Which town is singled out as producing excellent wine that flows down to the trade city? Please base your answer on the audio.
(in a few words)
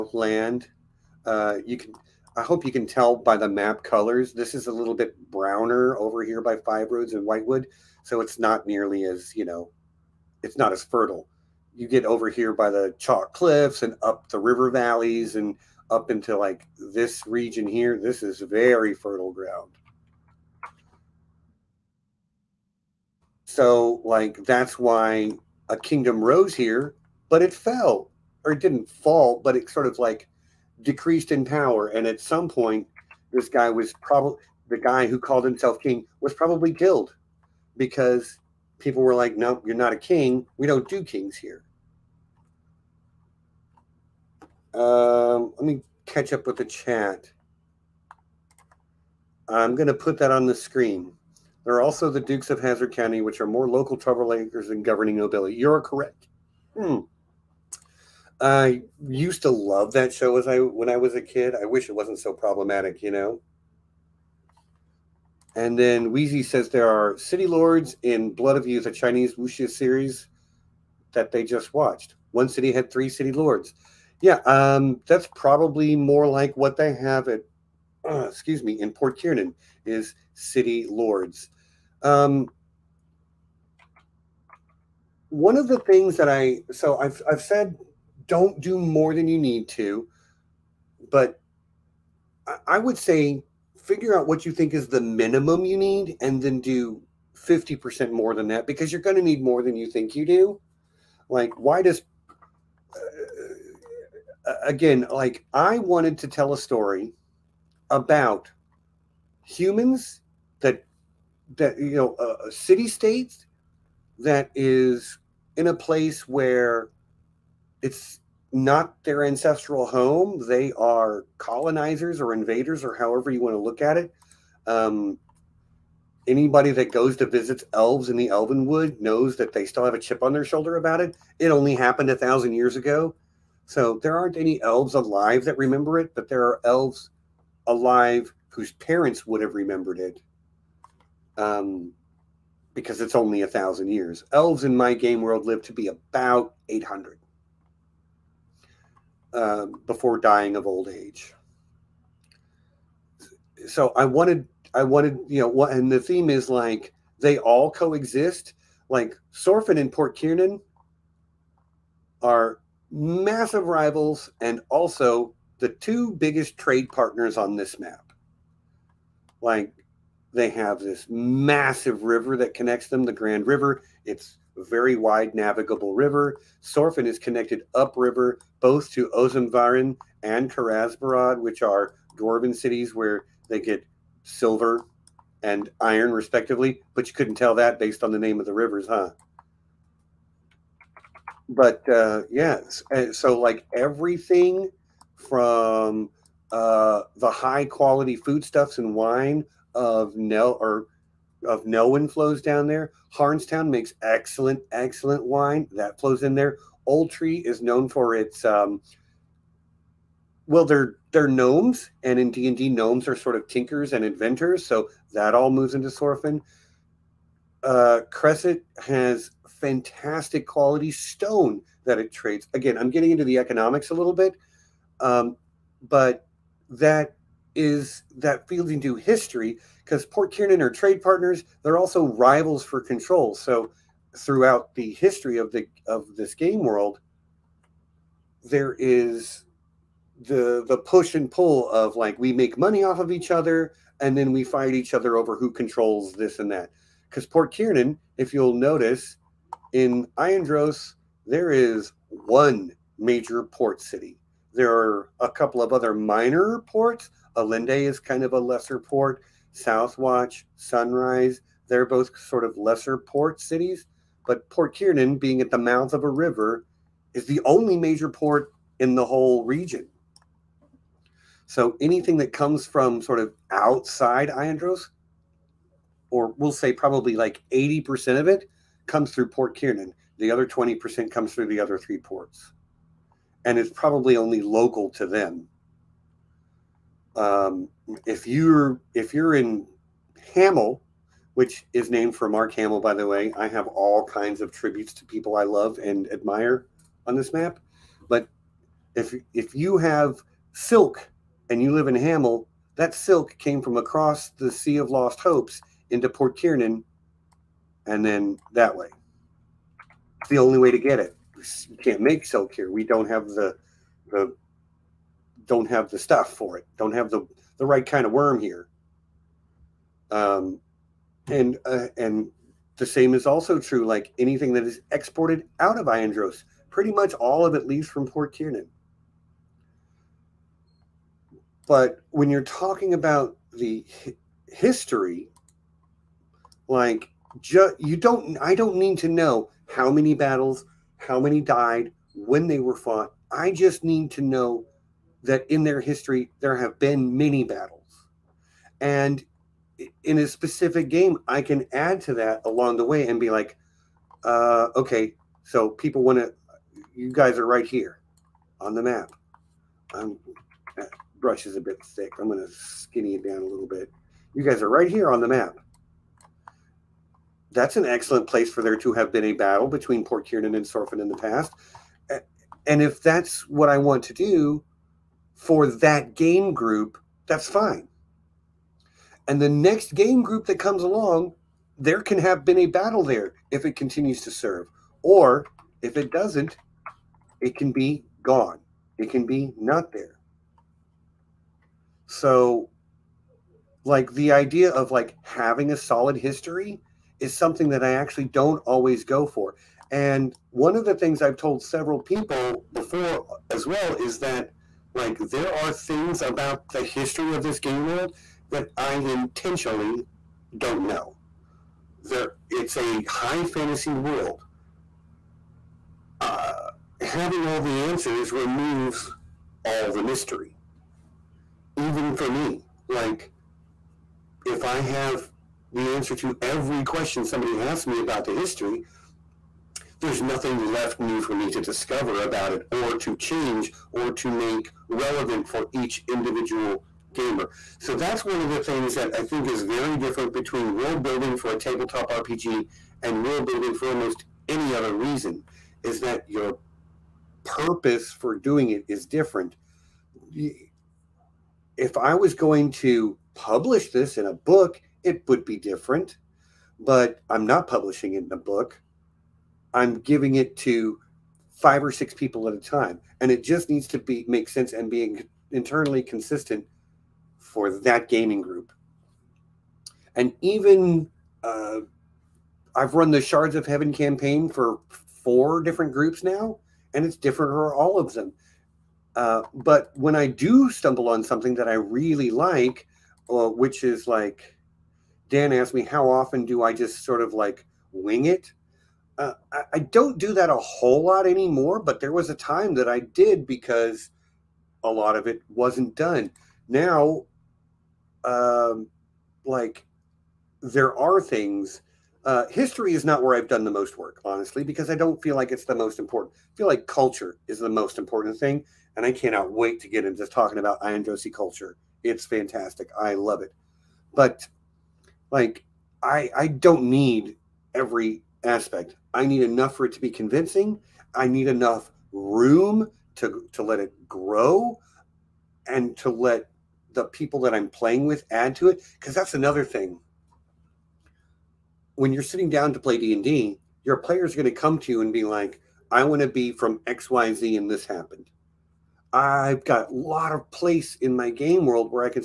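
Harnstown.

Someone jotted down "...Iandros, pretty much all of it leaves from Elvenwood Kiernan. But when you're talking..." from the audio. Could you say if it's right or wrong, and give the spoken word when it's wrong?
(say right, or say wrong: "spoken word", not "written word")
wrong: "Port", not "Elvenwood".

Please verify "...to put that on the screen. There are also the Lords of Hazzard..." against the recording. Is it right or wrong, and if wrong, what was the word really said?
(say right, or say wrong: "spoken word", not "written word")
wrong: "Dukes", not "Lords".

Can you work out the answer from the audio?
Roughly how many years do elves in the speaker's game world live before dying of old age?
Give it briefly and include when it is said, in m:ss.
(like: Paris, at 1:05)
800, at 2:25.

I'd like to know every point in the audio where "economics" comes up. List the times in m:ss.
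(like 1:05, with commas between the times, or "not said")
3:43.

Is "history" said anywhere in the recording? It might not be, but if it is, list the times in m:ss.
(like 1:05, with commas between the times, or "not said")
3:48, 3:54, 5:34, 5:45, 6:36, 6:46, 7:08, 8:22.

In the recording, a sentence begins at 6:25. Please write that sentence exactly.
Or if it doesn't, it can be gone, it can be not there.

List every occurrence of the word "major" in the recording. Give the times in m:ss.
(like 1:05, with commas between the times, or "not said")
4:12, 4:27.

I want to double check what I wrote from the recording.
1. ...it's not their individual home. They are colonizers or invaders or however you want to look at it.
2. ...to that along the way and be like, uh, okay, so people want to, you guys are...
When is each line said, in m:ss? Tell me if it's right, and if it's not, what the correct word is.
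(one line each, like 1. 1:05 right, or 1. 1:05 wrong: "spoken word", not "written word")
1. 1:57 wrong: "ancestral", not "individual"
2. 5:52 right.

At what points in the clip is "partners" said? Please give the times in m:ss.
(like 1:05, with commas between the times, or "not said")
2:46, 3:51.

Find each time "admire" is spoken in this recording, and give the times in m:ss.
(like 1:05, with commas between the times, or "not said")
4:56.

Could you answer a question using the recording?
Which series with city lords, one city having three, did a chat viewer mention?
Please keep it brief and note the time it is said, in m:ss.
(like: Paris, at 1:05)
Blood of Youth, at 1:08.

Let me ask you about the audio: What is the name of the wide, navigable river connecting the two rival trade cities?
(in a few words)
Grand River.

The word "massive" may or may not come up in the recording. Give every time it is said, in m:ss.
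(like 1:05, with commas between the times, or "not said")
2:42, 2:51.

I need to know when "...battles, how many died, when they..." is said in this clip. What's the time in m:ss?
5:40.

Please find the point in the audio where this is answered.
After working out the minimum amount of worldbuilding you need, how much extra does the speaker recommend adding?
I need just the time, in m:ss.
1:37.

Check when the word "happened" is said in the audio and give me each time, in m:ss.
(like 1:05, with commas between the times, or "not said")
2:11, 8:57.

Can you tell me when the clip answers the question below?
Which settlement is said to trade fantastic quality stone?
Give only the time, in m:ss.
3:38.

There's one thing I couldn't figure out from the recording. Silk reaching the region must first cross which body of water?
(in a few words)
Sea of Lost Hopes.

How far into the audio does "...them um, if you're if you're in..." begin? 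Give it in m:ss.
4:45.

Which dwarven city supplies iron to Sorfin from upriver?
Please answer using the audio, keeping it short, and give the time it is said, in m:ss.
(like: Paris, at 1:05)
Karazbarad, at 3:00.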